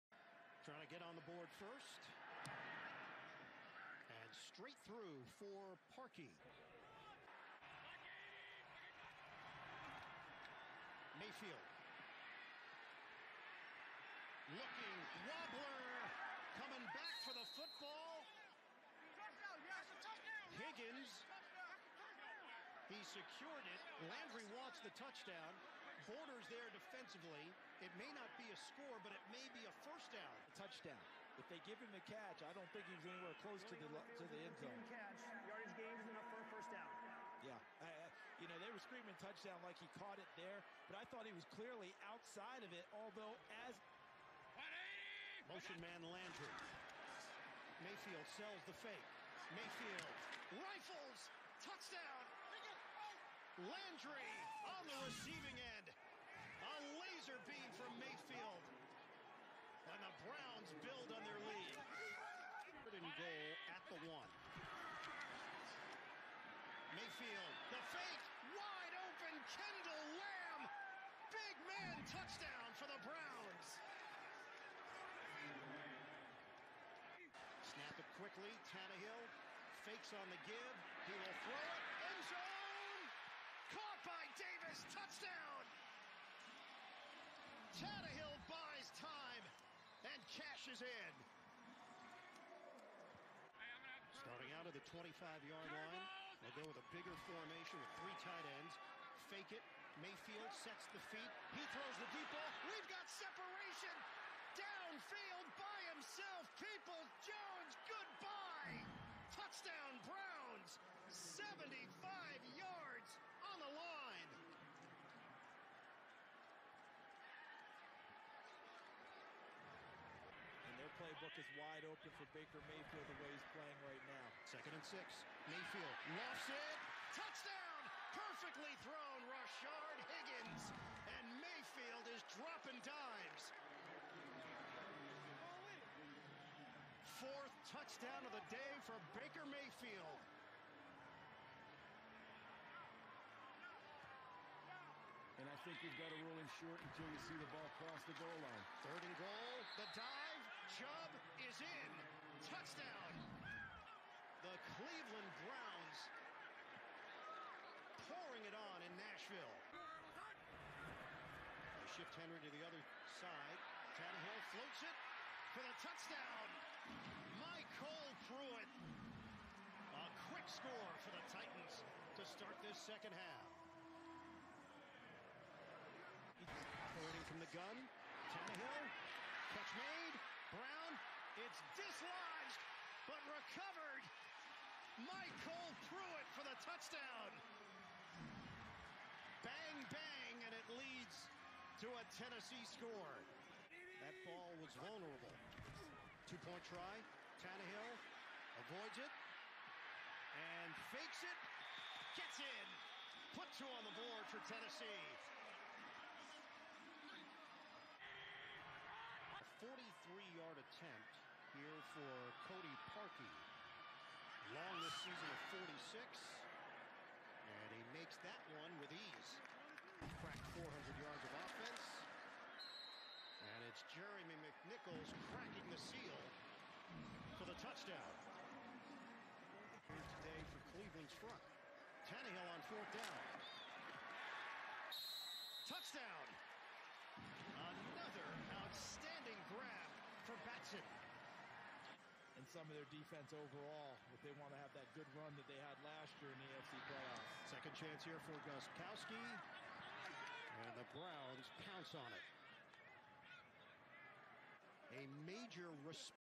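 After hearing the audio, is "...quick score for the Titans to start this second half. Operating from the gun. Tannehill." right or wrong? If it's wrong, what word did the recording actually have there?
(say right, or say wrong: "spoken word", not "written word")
right.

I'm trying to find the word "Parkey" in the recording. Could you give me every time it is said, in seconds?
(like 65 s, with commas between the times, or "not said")
5 s, 212 s.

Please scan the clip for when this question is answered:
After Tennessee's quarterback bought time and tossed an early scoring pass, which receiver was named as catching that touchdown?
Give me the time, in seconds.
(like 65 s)
84 s.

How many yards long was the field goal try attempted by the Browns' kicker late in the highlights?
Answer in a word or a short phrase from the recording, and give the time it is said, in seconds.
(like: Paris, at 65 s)
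43, at 209 s.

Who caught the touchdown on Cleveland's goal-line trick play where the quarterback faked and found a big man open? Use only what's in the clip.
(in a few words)
Kendall Lamm.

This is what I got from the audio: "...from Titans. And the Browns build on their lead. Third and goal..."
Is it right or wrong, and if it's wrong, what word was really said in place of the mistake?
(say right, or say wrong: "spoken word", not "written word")
wrong: "Mayfield", not "Titans".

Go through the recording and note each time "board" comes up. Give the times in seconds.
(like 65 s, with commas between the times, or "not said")
1 s, 203 s.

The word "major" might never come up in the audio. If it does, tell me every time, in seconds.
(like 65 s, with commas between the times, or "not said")
255 s.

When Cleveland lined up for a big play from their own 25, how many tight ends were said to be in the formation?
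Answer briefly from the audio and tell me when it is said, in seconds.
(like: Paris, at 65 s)
3, at 97 s.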